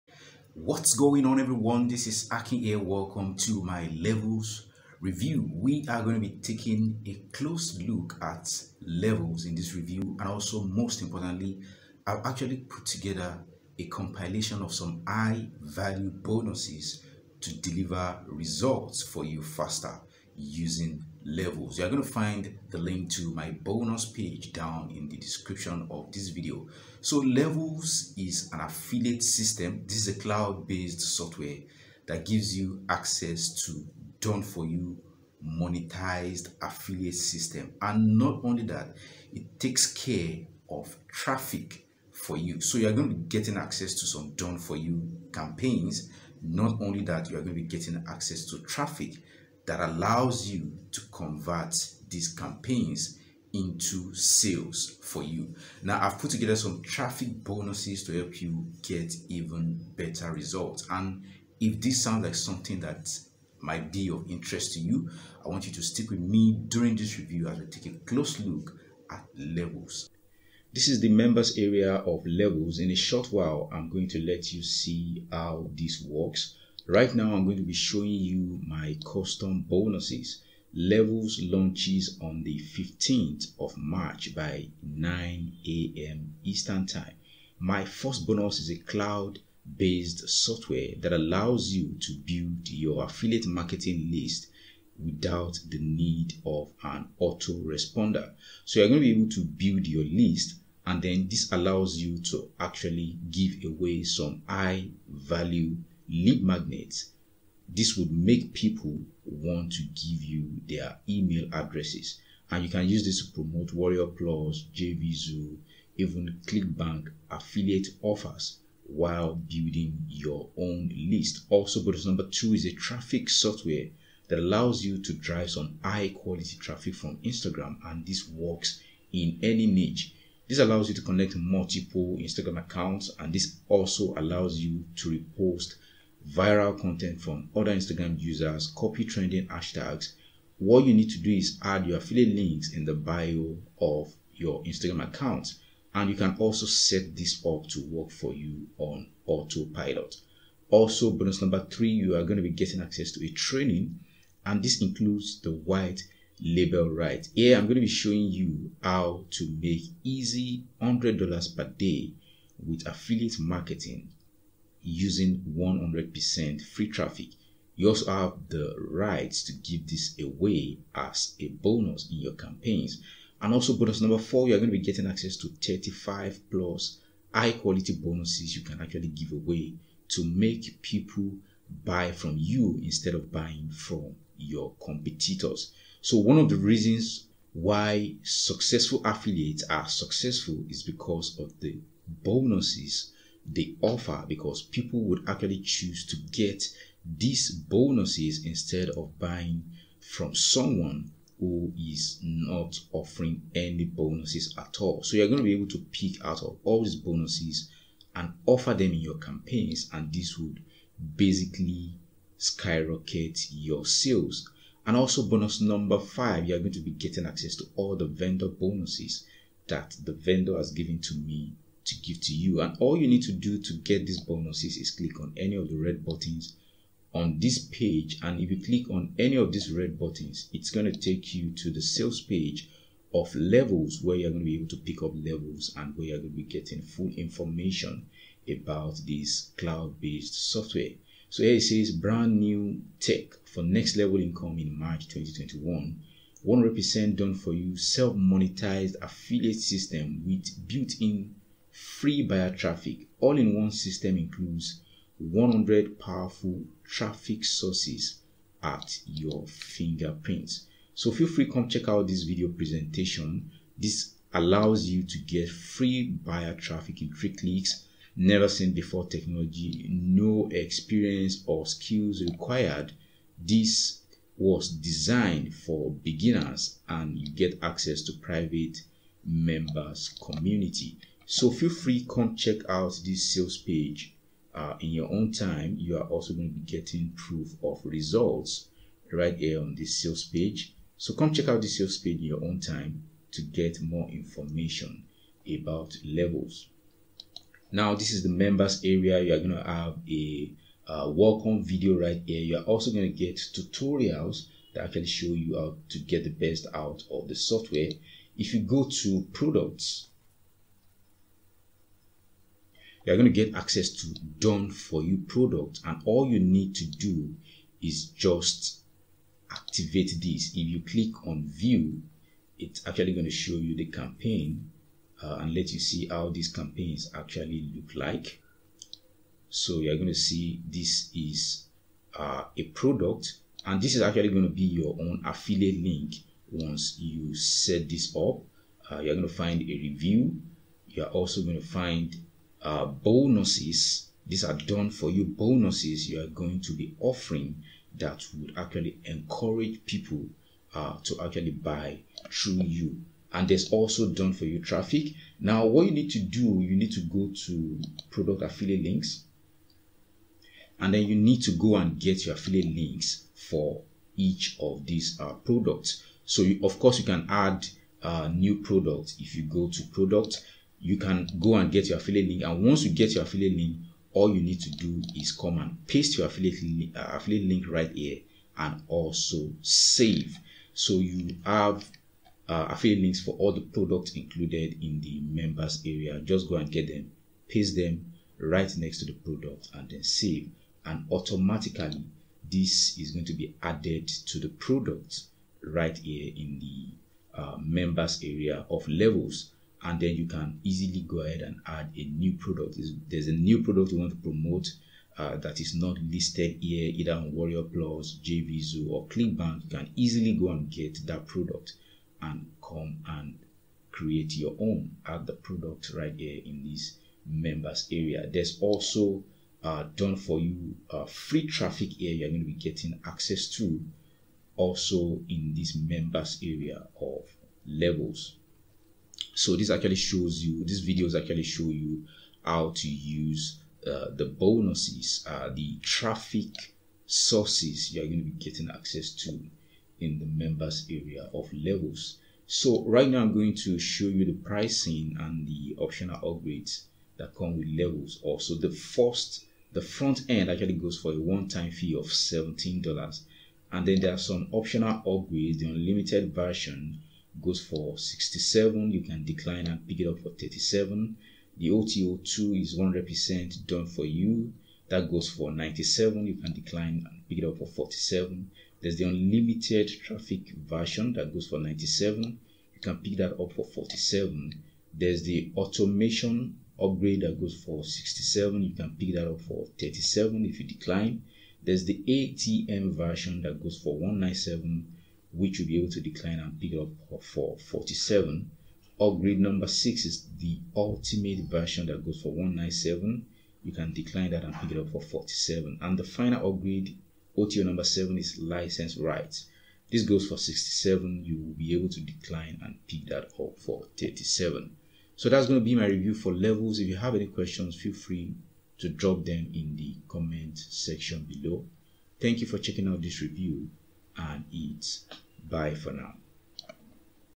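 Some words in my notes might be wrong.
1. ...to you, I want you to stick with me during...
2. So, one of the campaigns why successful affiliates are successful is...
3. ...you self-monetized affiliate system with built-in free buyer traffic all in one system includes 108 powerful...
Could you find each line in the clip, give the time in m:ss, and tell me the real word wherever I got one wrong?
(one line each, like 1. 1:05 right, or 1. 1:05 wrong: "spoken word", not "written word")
1. 1:04 right
2. 3:06 wrong: "reasons", not "campaigns"
3. 4:07 wrong: "100", not "108".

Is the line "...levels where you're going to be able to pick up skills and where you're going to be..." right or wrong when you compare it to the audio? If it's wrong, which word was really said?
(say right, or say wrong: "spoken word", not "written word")
wrong: "levels", not "skills".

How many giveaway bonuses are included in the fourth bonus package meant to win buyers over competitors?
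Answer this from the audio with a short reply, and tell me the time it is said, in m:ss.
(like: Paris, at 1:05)
35, at 2:55.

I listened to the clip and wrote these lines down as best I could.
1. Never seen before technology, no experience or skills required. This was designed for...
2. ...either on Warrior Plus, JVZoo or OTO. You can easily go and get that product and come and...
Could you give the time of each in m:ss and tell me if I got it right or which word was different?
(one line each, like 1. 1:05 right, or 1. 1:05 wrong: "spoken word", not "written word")
1. 4:28 right
2. 6:46 wrong: "ClickBank", not "OTO".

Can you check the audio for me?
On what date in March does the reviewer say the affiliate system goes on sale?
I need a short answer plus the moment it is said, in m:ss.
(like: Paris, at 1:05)
15th of March, at 1:22.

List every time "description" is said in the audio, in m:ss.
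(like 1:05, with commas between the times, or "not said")
0:25.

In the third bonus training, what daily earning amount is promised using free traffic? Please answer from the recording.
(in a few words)
$100 per day.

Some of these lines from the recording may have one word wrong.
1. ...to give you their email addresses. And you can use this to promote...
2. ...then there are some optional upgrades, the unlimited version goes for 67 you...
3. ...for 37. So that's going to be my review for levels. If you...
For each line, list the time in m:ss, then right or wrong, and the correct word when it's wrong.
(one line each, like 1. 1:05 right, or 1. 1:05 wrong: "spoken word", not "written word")
1. 1:49 right
2. 7:33 right
3. 8:23 right.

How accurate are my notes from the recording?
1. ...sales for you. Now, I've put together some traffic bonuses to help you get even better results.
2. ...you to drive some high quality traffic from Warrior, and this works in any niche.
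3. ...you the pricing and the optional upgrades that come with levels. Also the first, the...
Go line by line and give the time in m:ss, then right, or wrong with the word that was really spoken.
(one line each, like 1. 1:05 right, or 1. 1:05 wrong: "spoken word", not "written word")
1. 0:54 right
2. 2:04 wrong: "Instagram", not "Warrior"
3. 7:24 right.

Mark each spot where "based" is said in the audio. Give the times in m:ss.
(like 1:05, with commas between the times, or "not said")
0:30, 1:29, 3:59.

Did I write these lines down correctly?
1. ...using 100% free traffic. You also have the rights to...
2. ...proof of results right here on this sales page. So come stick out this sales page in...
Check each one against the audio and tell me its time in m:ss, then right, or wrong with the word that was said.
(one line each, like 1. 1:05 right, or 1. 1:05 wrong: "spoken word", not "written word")
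1. 2:44 right
2. 4:47 wrong: "check", not "stick".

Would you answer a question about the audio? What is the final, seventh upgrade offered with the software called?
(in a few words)
License rights.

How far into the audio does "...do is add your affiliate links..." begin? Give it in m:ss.
2:21.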